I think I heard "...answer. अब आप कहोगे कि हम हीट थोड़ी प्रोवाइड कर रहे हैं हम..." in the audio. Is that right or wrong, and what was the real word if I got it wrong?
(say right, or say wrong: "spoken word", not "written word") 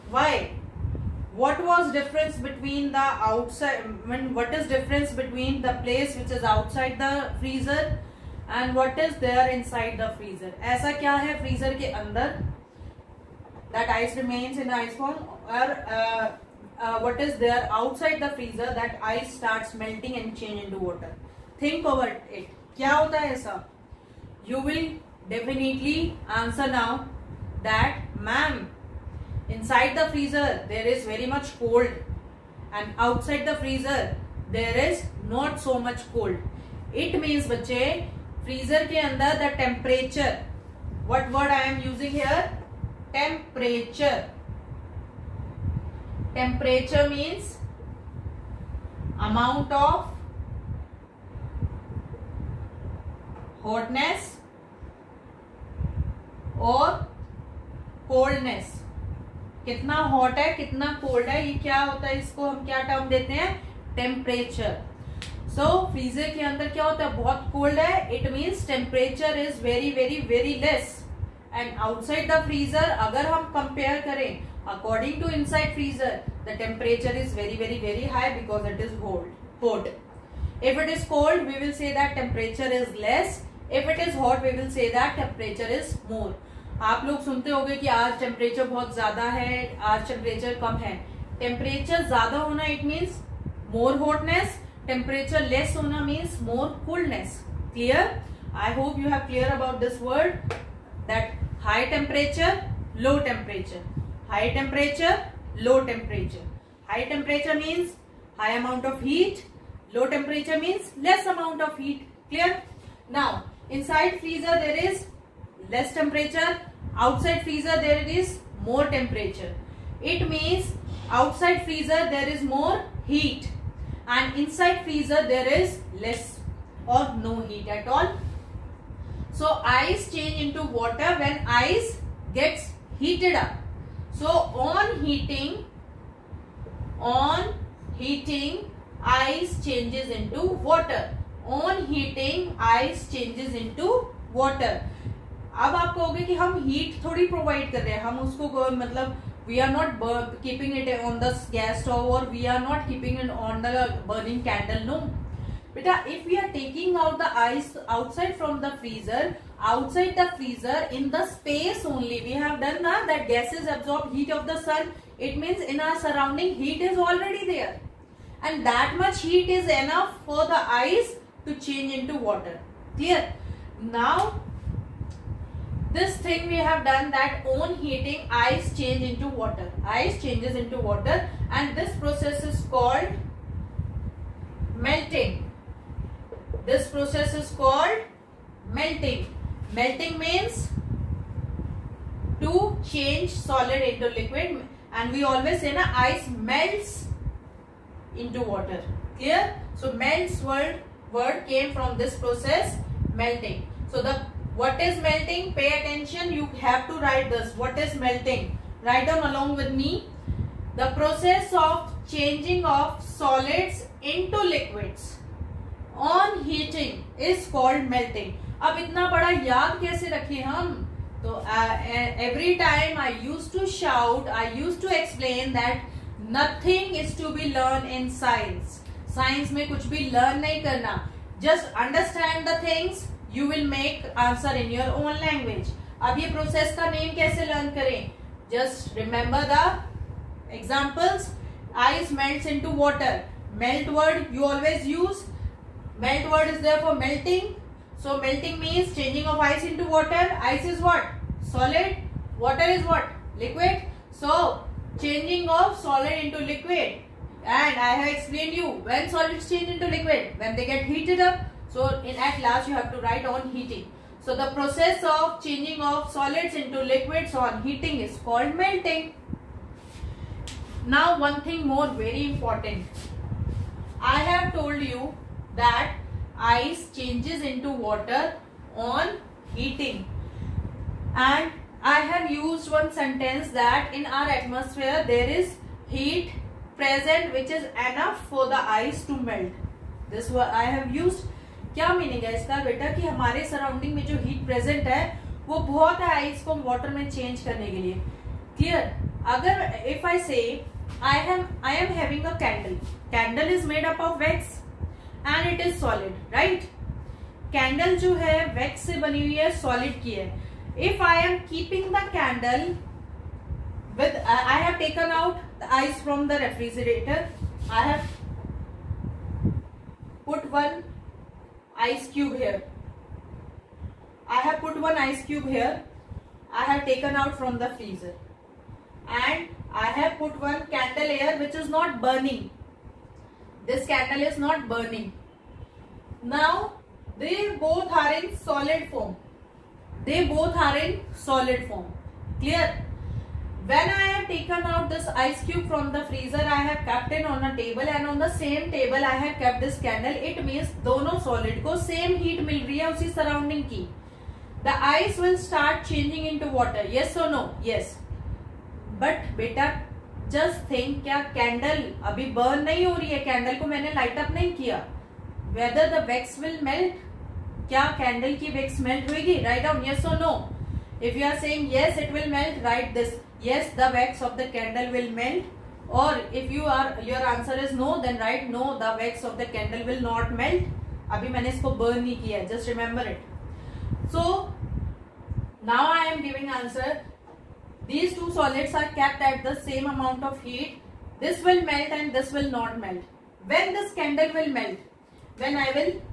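wrong: "water", not "answer".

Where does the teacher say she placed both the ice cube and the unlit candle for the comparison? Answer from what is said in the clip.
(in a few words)
on a table.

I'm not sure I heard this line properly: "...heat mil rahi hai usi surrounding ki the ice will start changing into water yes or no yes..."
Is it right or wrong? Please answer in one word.
right.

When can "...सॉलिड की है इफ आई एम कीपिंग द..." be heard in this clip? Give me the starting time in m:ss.
5:09.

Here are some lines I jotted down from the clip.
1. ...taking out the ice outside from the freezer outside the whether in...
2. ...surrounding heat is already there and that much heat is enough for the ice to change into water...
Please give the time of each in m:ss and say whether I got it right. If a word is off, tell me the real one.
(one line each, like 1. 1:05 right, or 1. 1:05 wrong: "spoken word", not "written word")
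1. 2:36 wrong: "freezer", not "whether"
2. 2:46 right.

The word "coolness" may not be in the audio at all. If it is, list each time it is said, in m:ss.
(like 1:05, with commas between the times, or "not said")
1:36.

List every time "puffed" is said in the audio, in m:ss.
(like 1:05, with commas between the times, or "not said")
not said.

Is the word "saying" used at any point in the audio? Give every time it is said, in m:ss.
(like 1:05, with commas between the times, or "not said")
6:11.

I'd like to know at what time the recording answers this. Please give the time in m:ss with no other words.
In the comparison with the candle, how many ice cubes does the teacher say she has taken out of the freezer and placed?
5:24.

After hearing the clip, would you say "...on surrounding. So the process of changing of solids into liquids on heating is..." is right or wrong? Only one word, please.
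wrong.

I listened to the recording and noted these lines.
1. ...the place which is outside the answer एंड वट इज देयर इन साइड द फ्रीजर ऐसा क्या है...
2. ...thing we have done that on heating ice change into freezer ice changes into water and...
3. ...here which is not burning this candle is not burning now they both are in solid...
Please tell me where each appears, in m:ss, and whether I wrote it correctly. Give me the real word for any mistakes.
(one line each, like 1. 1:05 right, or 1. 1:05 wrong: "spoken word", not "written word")
1. 0:05 wrong: "freezer", not "answer"
2. 2:56 wrong: "water", not "freezer"
3. 5:31 right.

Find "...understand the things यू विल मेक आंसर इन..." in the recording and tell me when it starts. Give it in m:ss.
3:51.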